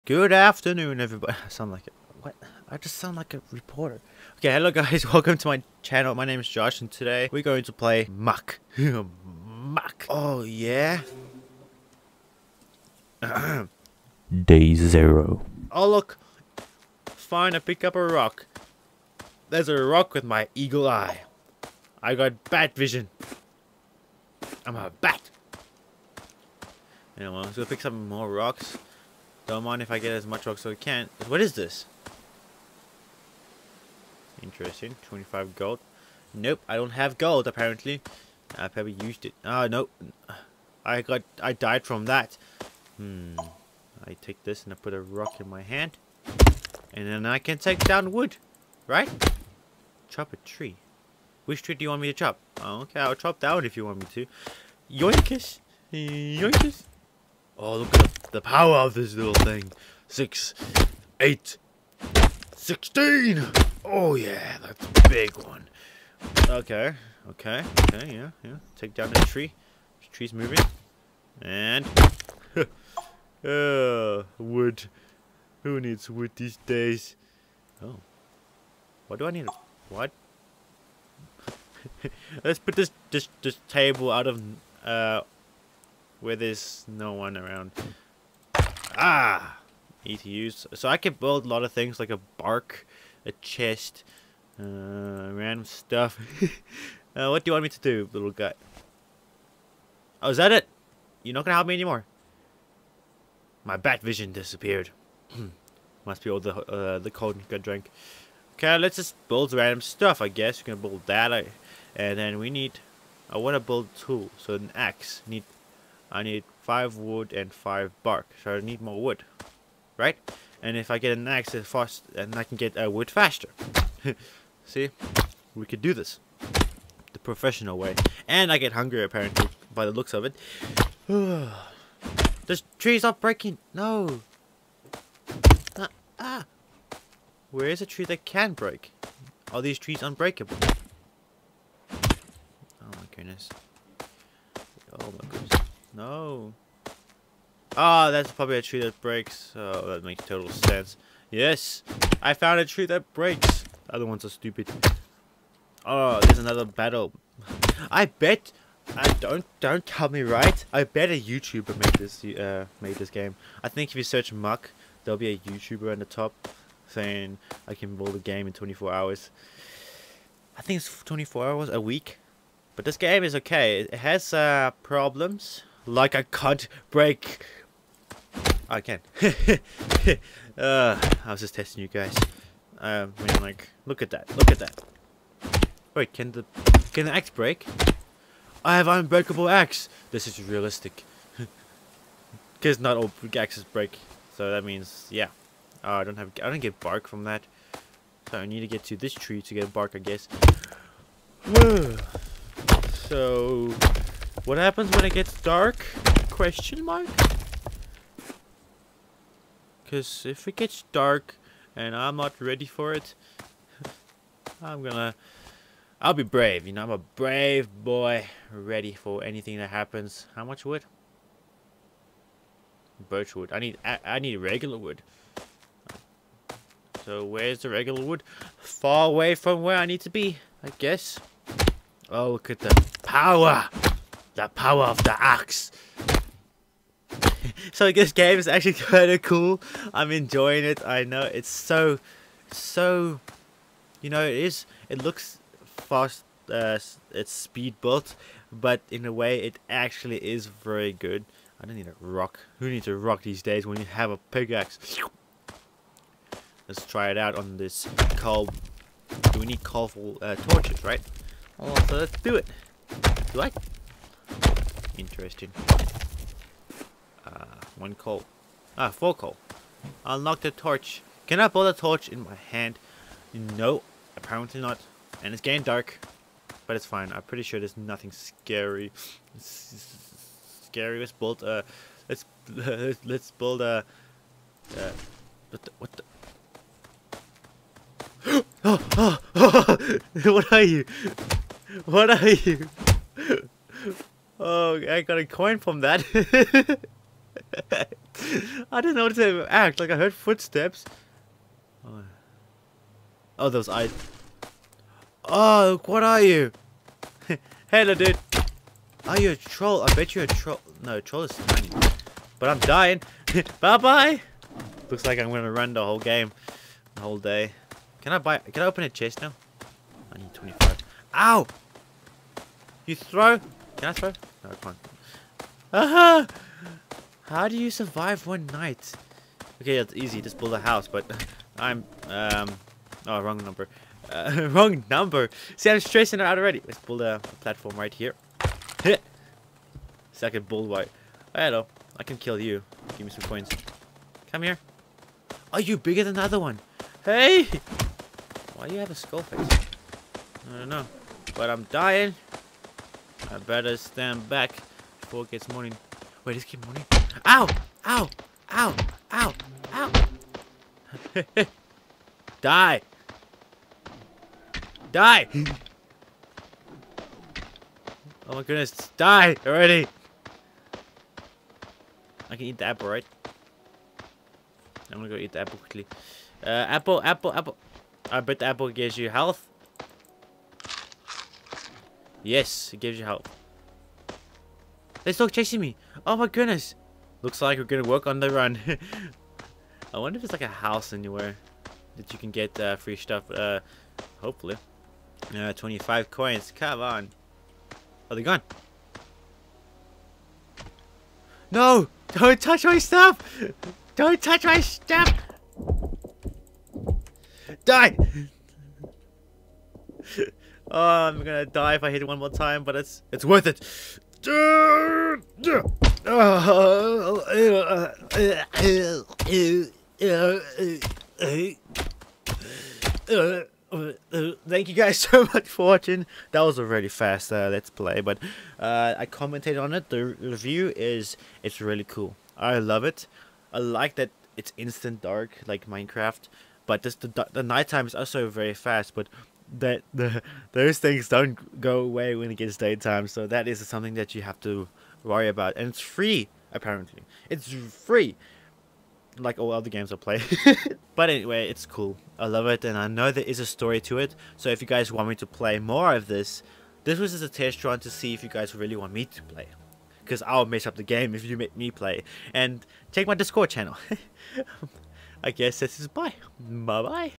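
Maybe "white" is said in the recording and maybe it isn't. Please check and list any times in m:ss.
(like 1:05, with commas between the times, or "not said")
5:40.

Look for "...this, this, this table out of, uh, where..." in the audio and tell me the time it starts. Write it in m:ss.
1:22.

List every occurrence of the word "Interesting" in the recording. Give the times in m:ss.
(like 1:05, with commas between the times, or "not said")
0:34, 4:24.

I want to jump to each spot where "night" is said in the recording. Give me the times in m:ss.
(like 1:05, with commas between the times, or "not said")
5:28, 7:17.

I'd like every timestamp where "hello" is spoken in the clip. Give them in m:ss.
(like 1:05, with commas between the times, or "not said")
0:04, 5:07, 5:41.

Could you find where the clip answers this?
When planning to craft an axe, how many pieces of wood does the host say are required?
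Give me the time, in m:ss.
1:56.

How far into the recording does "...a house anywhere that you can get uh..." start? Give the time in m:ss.
6:30.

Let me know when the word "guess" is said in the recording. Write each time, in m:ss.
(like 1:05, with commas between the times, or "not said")
1:50, 3:19, 3:50, 7:45.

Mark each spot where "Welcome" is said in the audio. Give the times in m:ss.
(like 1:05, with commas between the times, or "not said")
0:05.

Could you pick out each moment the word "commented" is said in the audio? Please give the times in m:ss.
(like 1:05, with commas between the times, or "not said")
7:09.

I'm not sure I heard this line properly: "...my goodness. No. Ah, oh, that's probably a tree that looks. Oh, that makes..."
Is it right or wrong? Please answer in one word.
wrong.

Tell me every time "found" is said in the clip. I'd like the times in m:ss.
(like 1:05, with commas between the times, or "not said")
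2:32.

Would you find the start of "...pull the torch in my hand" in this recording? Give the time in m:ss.
4:31.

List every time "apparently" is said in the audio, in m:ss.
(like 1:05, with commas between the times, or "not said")
0:37, 2:09, 4:34, 7:26.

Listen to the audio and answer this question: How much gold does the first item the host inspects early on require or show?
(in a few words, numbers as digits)
25.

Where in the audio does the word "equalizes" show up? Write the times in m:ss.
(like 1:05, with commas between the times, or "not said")
not said.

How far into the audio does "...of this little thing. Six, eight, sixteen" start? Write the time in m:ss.
0:58.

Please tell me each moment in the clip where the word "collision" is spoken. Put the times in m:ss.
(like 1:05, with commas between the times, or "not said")
not said.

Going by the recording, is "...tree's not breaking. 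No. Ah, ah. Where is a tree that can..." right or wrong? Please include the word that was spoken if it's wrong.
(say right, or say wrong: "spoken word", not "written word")
right.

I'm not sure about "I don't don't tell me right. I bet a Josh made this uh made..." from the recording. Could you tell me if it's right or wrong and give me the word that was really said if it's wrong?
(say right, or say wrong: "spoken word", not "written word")
wrong: "YouTuber", not "Josh".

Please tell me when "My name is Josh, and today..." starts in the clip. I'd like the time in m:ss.
0:06.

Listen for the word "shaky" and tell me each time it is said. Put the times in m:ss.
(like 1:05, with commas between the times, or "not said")
not said.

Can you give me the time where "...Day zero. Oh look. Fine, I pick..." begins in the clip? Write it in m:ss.
0:13.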